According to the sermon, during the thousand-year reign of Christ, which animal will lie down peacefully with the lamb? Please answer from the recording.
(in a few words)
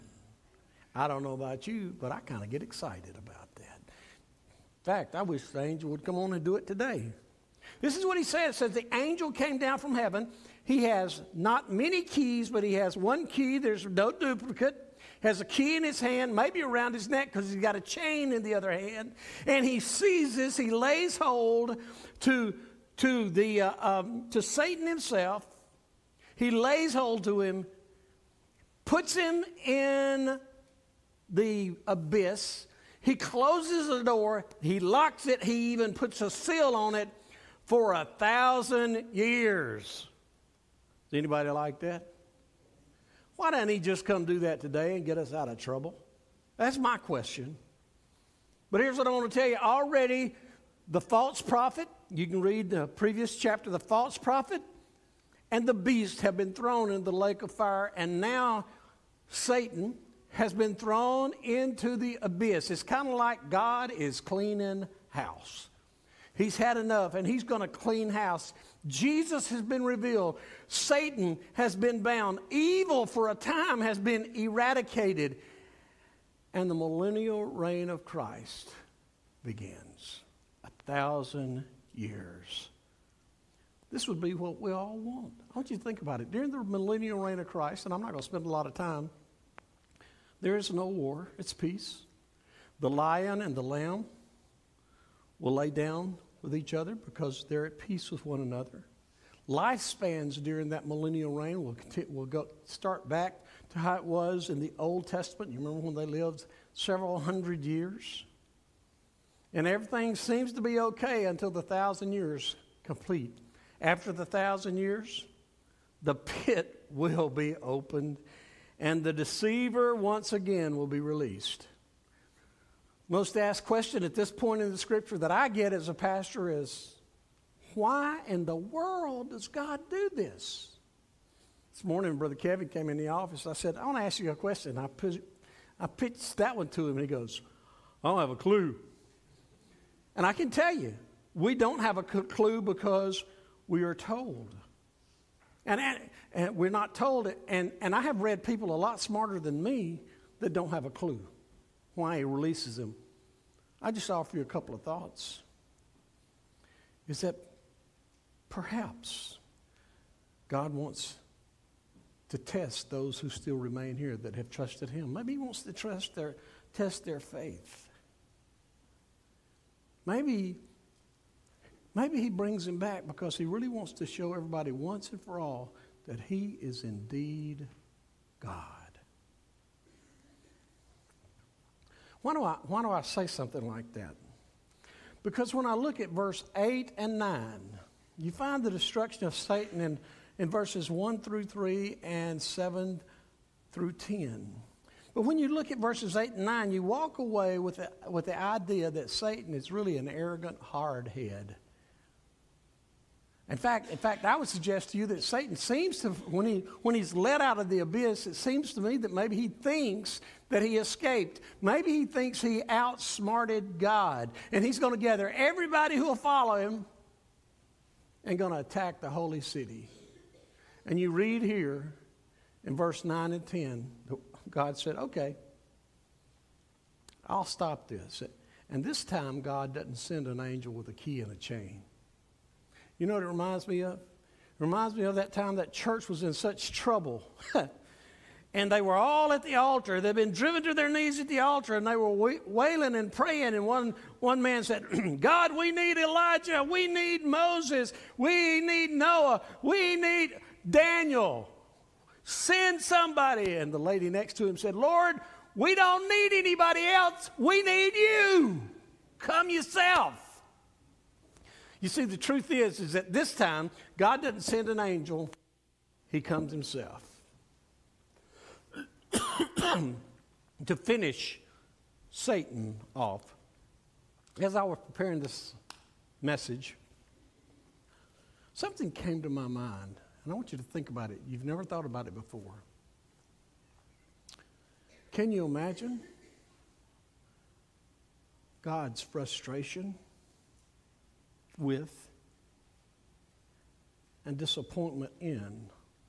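The lion.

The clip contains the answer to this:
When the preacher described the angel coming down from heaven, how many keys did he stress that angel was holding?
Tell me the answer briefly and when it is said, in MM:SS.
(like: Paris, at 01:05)
1, at 00:12.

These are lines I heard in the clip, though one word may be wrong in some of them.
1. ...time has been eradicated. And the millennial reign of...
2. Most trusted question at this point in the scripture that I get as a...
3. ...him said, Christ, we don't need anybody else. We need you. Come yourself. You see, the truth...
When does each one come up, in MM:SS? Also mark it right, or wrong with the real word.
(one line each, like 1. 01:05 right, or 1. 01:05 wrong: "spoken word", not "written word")
1. 01:13 right
2. 02:03 wrong: "asked", not "trusted"
3. 04:14 wrong: "Lord", not "Christ".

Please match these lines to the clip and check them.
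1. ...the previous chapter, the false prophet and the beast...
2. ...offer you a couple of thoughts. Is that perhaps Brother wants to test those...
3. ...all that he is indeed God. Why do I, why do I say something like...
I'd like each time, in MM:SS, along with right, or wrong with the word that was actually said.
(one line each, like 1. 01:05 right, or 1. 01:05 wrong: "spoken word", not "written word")
1. 00:52 right
2. 02:34 wrong: "God", not "Brother"
3. 02:55 right.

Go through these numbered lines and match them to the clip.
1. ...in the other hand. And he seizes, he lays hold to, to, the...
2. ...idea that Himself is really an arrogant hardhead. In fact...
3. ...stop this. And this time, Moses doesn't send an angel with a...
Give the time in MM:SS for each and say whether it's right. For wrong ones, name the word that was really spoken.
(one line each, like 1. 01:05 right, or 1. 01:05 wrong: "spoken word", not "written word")
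1. 00:18 right
2. 03:18 wrong: "Satan", not "Himself"
3. 03:47 wrong: "God", not "Moses".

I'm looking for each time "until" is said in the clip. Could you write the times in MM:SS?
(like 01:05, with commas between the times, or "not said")
01:51.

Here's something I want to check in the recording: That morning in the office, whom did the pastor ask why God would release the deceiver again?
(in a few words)
Brother Kevin.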